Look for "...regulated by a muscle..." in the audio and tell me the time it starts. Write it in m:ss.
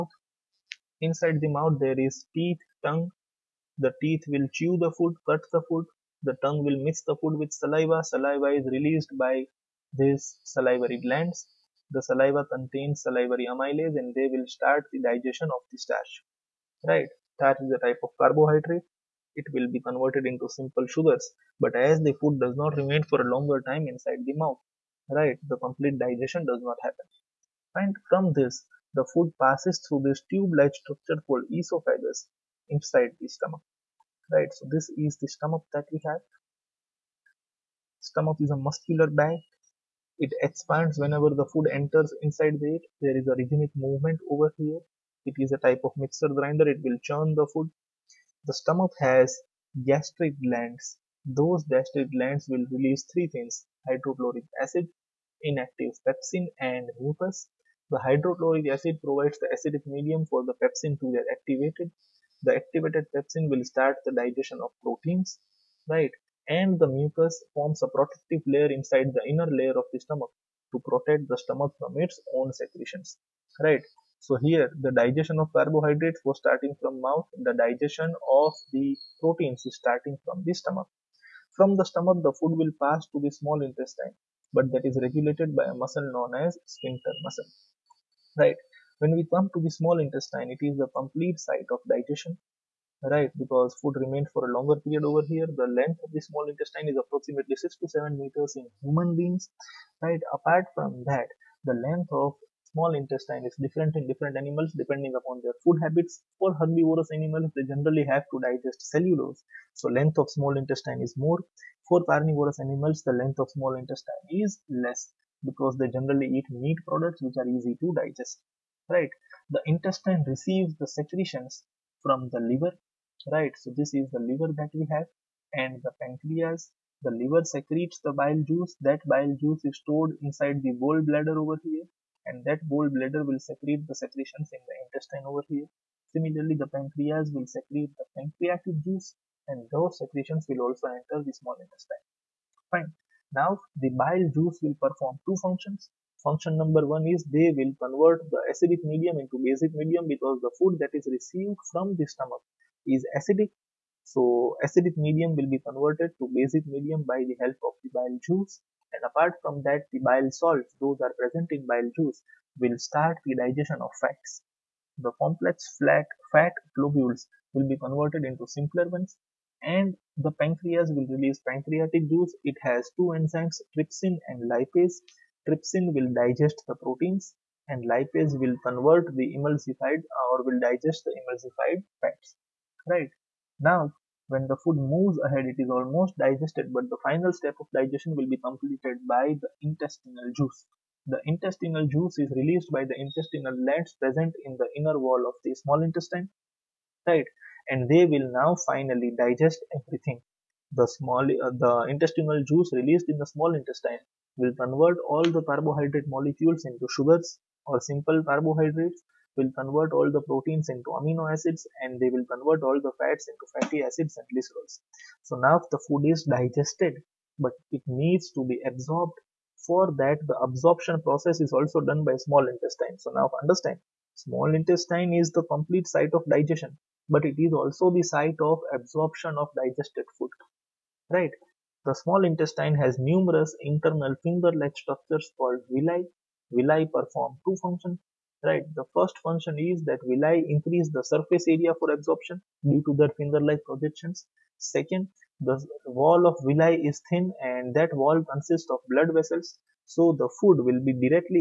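1:25.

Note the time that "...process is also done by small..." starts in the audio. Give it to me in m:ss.
3:41.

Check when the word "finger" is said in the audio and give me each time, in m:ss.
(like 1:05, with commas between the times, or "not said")
3:54, 4:03.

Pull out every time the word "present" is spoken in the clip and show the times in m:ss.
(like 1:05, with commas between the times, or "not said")
2:41, 3:13.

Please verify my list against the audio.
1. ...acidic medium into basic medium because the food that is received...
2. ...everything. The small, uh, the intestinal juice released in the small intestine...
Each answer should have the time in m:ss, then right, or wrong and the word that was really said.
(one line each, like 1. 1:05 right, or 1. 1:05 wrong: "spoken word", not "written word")
1. 2:28 right
2. 3:19 right.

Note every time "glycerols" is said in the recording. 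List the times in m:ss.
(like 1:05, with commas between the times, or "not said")
3:34.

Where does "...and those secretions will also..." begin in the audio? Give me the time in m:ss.
2:19.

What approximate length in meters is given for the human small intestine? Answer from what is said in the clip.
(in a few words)
6 to 7 meters.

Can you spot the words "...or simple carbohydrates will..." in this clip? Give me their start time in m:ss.
3:27.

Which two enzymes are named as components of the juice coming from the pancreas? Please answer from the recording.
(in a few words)
trypsin and lipase.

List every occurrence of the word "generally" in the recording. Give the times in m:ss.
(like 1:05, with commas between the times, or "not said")
1:47, 1:55.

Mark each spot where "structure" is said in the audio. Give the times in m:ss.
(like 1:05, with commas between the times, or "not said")
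0:30, 3:54.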